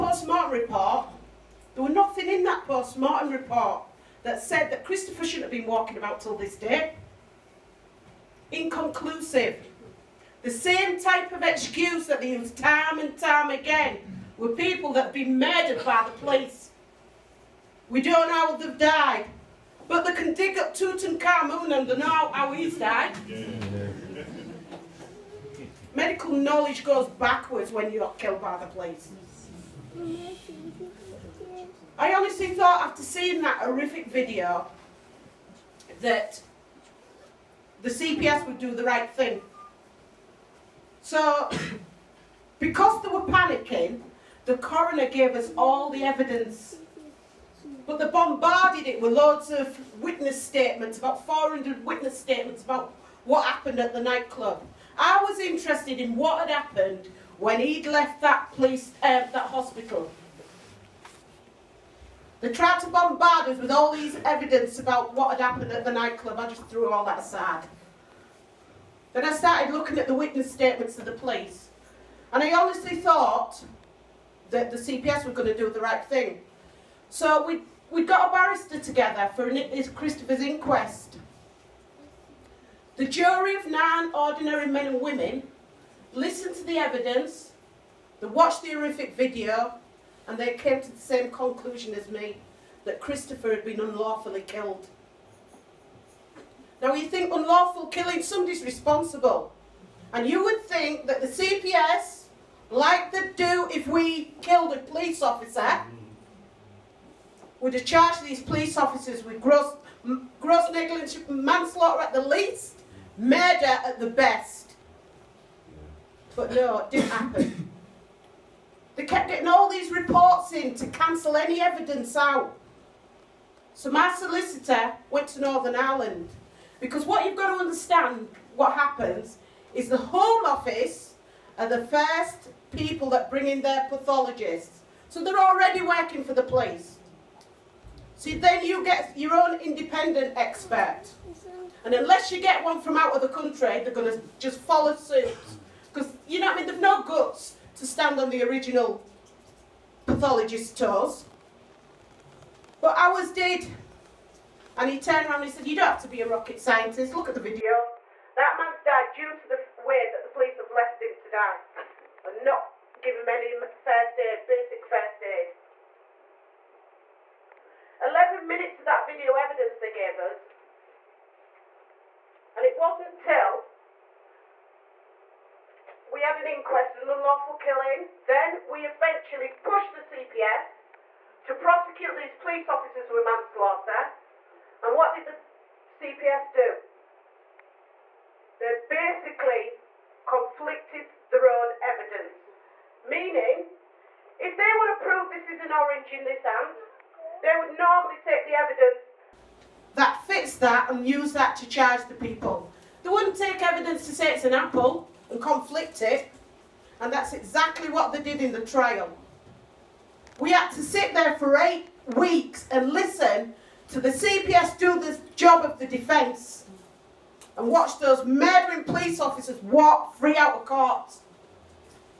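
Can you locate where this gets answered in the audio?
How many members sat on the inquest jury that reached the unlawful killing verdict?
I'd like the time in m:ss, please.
1:23.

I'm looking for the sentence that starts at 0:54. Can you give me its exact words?
I was interested in what had happened when he'd left that police, uh, that hospital.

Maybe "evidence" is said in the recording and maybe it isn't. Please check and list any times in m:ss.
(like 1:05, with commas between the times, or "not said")
0:46, 1:04, 1:26, 2:01, 2:49, 3:11, 3:18, 3:23.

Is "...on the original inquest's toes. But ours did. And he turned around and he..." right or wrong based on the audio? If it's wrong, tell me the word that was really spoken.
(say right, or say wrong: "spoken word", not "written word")
wrong: "pathologist", not "inquest".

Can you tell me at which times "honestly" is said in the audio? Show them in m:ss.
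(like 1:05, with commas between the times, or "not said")
0:32, 1:12.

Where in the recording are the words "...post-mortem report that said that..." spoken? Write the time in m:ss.
0:02.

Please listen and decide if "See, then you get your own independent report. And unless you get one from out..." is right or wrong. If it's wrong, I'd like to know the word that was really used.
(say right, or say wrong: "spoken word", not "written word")
wrong: "expert", not "report".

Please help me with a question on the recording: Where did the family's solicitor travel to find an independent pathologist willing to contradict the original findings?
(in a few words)
Northern Ireland.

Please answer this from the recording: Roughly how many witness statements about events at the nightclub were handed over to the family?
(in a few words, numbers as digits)
400.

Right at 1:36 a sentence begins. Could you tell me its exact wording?
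Now you think unlawful killing, somebody's responsible.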